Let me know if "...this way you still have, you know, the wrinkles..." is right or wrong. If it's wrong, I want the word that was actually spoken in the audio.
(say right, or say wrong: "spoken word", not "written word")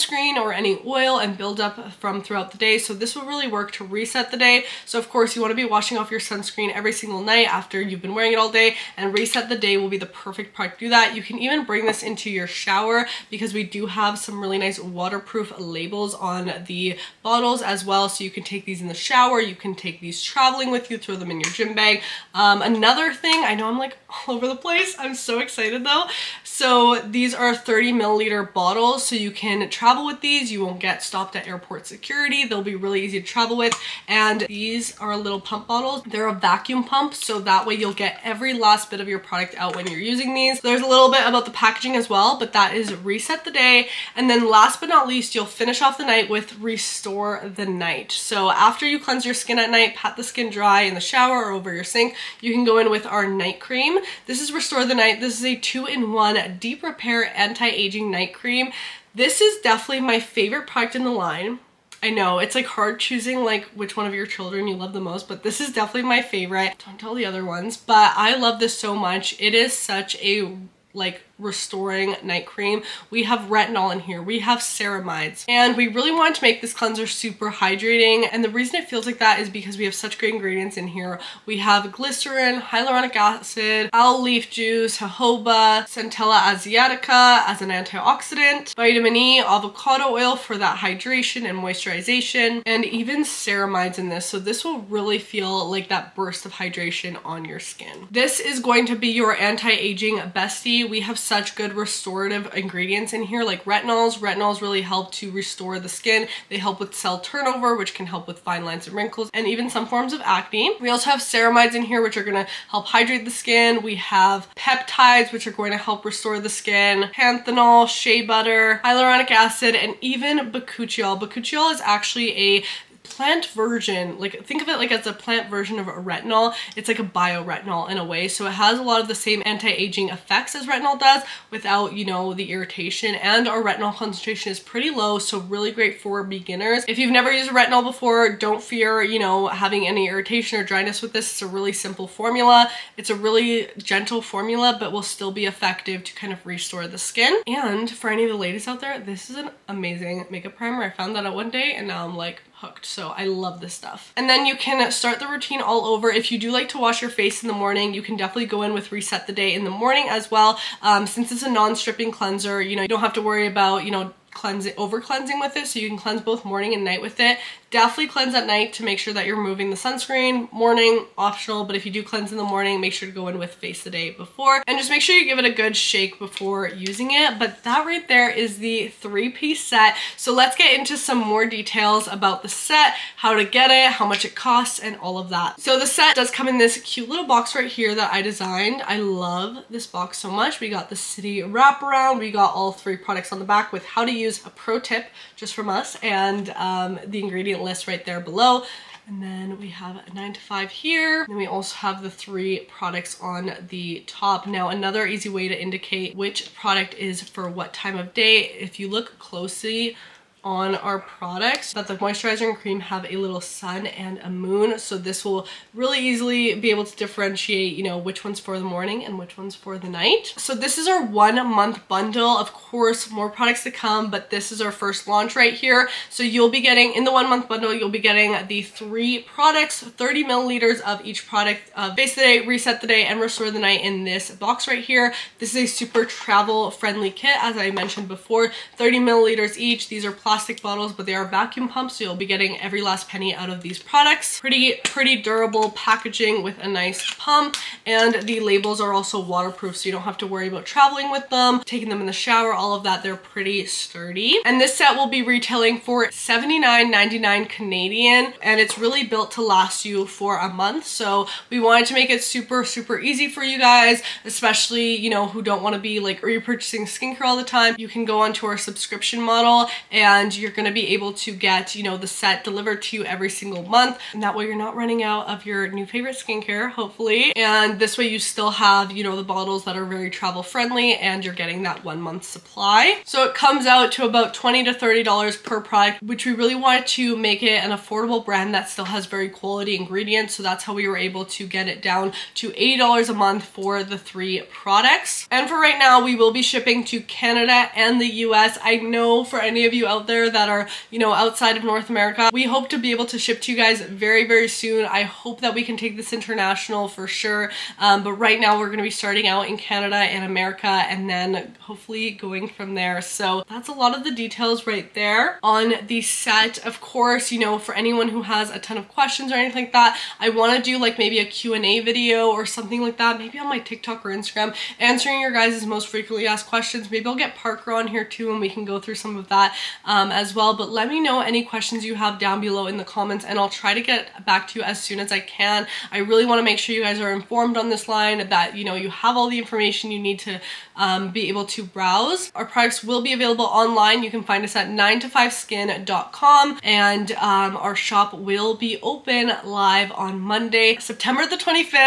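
wrong: "bottles", not "wrinkles".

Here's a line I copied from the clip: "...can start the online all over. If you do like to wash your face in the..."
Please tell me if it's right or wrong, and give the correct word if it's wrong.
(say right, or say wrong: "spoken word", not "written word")
wrong: "routine", not "online".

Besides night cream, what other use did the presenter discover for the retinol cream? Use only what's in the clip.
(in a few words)
Makeup primer.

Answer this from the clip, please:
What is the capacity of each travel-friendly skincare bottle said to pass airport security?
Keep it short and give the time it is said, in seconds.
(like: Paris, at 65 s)
30 milliliters, at 27 s.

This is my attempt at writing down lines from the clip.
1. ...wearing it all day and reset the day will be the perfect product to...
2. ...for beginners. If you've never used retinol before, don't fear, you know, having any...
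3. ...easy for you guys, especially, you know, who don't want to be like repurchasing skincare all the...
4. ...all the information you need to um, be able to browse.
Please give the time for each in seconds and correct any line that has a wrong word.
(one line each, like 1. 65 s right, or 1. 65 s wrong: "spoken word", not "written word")
1. 8 s right
2. 135 s right
3. 262 s right
4. 339 s right.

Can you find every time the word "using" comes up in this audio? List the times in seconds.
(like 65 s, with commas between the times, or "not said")
39 s, 176 s.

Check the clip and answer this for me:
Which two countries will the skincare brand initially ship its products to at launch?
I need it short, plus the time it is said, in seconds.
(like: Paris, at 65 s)
Canada and the US, at 297 s.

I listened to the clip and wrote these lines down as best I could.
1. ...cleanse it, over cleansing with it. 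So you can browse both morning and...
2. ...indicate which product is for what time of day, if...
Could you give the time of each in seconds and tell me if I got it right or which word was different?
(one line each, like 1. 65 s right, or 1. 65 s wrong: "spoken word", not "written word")
1. 164 s wrong: "cleanse", not "browse"
2. 205 s right.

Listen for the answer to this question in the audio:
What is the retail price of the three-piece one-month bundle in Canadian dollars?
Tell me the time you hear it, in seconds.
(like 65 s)
256 s.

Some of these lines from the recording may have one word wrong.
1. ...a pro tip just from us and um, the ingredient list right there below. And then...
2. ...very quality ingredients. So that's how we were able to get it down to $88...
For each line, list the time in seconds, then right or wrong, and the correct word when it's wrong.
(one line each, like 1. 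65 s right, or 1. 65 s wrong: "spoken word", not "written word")
1. 194 s right
2. 289 s wrong: "80", not "88".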